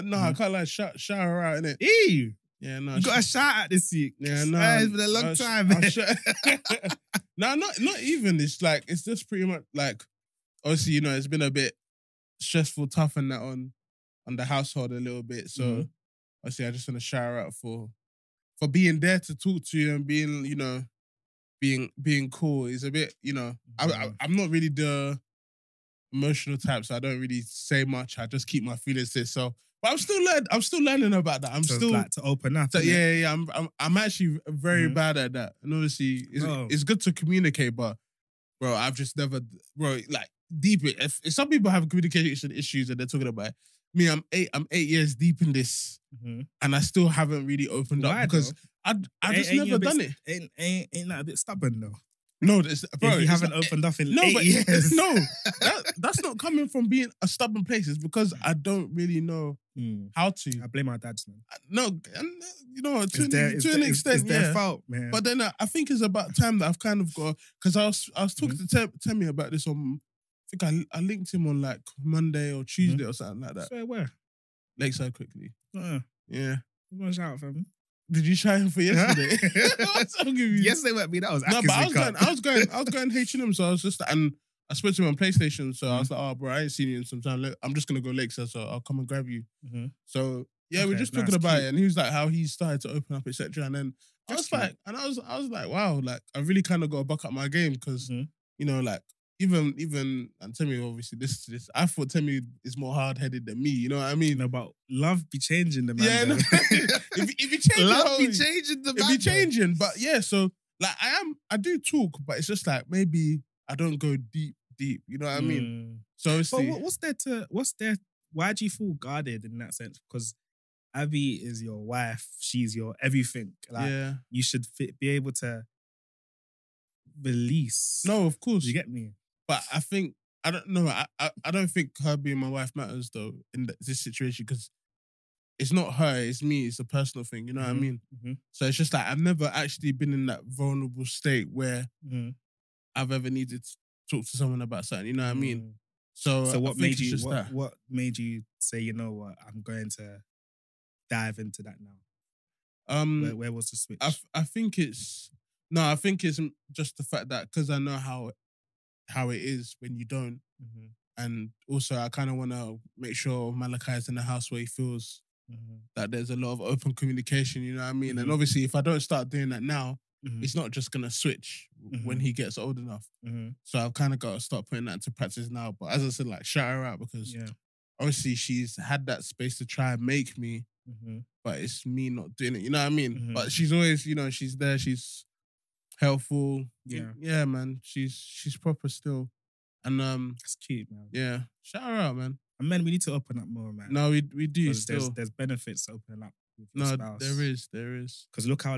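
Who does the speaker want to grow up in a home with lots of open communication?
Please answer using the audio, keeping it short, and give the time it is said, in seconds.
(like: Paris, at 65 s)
Malachi, at 163 s.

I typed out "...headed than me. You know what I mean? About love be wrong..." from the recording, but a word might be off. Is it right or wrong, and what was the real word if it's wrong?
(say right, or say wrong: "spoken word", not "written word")
wrong: "changing", not "wrong".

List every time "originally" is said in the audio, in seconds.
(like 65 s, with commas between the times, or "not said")
not said.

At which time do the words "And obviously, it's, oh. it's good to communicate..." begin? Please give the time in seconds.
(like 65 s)
35 s.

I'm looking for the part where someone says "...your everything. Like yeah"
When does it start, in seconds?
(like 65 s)
122 s.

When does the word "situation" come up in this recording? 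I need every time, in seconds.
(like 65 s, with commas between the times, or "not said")
134 s.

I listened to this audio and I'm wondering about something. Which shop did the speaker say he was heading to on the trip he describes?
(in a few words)
H and M.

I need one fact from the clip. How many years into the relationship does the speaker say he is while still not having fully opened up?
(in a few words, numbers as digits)
8.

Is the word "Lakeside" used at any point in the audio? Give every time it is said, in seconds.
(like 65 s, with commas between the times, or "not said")
74 s, 88 s.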